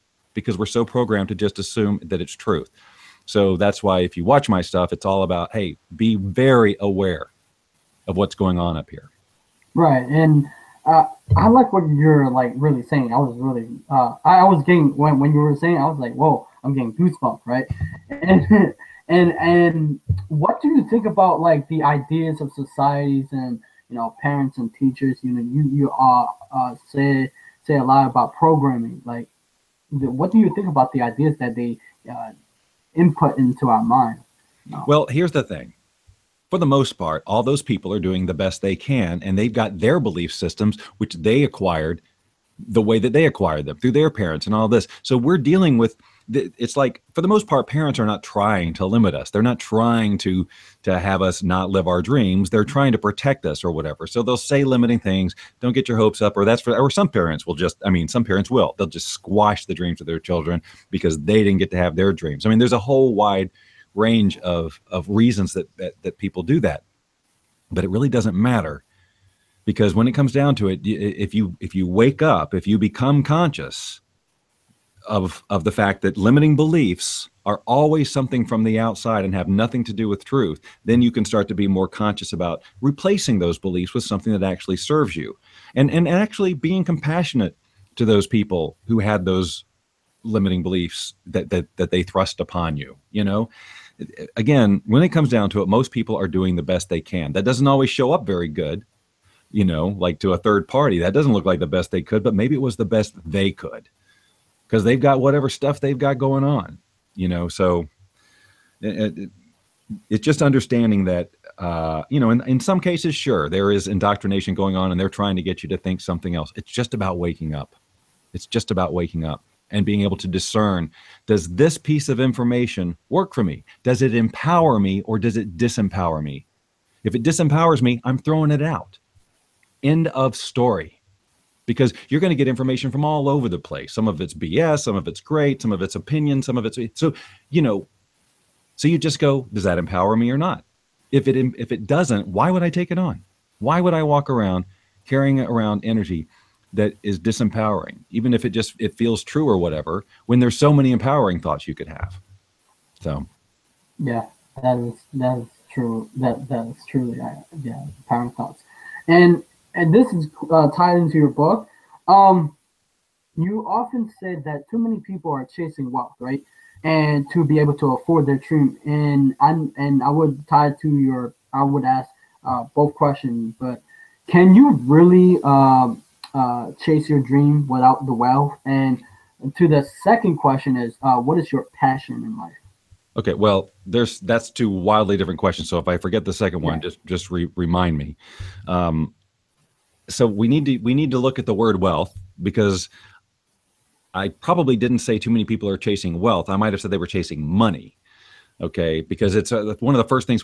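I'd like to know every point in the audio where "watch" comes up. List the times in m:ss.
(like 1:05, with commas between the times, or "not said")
0:04.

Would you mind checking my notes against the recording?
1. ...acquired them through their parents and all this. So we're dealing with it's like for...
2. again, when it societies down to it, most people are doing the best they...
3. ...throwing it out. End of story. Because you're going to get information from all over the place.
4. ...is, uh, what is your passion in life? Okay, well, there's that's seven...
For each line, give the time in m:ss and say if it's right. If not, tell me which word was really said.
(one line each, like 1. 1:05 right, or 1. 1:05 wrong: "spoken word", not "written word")
1. 0:43 right
2. 1:34 wrong: "comes", not "societies"
3. 2:08 right
4. 3:00 wrong: "two", not "seven".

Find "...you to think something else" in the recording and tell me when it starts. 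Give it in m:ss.
1:55.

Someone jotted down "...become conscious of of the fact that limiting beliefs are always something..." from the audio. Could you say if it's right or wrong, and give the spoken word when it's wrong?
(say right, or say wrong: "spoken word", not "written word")
right.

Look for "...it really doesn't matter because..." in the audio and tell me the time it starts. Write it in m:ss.
1:07.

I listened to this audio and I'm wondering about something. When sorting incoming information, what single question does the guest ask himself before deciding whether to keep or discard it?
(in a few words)
Does it empower me.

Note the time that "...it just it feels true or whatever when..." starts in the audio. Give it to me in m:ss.
2:28.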